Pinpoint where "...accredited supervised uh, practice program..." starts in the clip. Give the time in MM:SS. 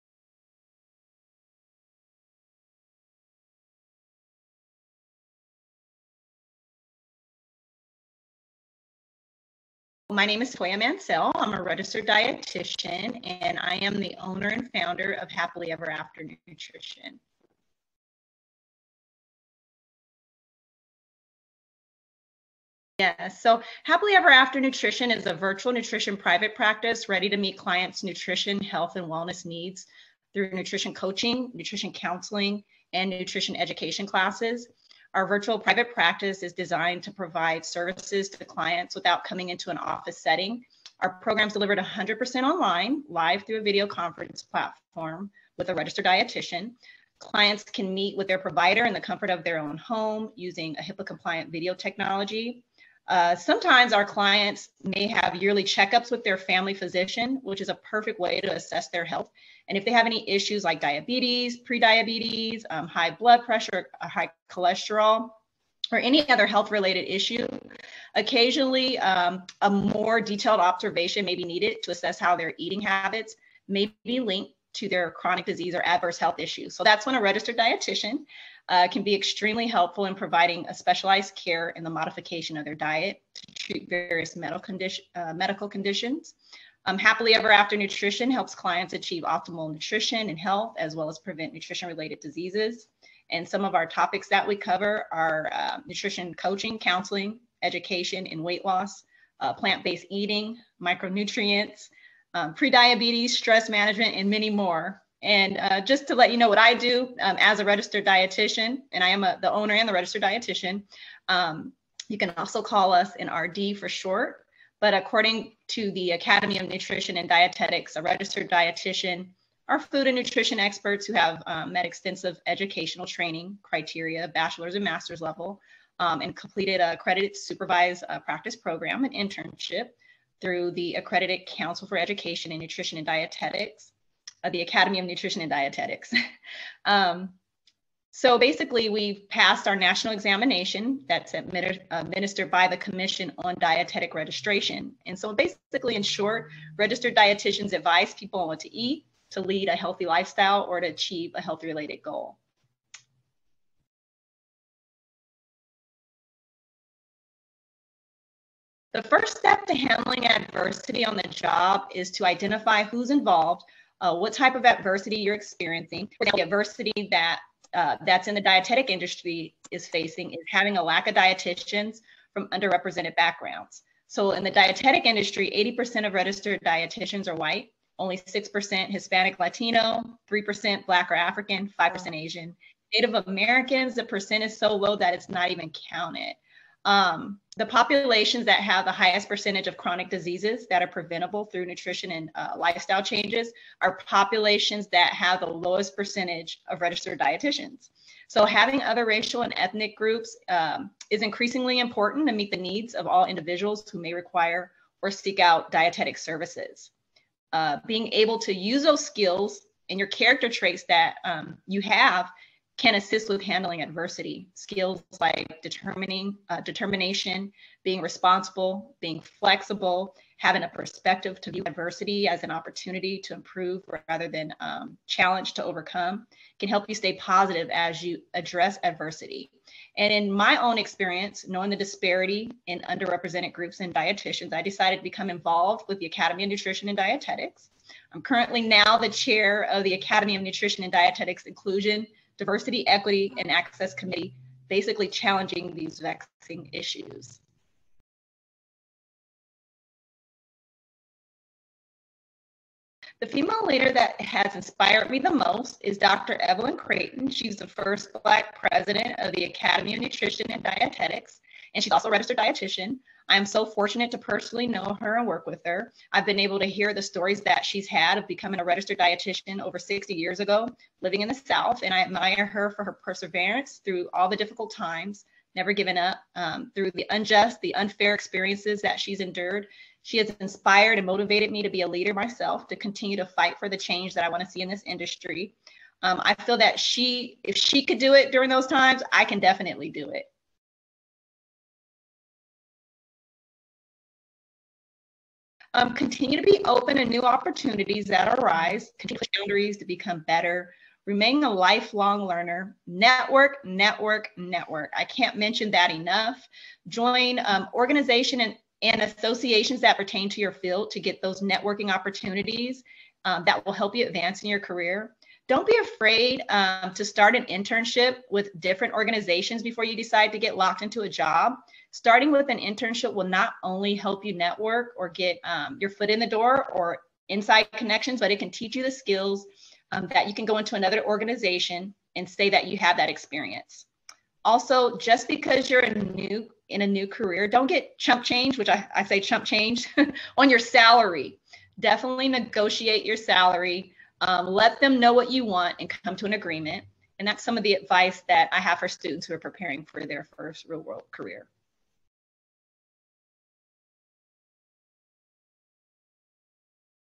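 02:06.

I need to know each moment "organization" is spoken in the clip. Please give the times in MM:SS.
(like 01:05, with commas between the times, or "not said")
05:07, 05:18, 05:31.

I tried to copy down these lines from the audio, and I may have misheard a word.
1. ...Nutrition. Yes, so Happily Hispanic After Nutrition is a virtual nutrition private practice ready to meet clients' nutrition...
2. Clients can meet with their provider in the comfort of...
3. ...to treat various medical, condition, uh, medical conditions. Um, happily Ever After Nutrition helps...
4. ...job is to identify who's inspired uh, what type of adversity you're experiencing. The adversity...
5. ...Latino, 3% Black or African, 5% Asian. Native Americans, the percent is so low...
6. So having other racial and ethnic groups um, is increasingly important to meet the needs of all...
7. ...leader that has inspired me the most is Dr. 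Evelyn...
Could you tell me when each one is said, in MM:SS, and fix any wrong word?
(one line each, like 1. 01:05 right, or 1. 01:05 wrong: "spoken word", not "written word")
1. 00:16 wrong: "Ever", not "Hispanic"
2. 00:47 right
3. 01:23 right
4. 02:41 wrong: "involved", not "inspired"
5. 02:59 right
6. 03:18 right
7. 04:13 right.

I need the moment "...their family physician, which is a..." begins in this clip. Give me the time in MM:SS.
00:56.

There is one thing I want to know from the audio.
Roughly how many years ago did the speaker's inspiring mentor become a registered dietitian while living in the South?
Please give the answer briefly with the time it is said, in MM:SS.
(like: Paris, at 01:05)
60 years, at 04:29.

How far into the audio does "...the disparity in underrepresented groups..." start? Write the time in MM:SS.
03:51.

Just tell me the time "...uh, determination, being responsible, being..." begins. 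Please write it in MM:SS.
03:36.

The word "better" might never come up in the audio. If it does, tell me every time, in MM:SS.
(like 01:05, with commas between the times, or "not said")
05:00.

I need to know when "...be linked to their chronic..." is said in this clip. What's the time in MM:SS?
01:14.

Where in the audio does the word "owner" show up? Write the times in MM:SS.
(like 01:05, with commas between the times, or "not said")
00:14, 01:49.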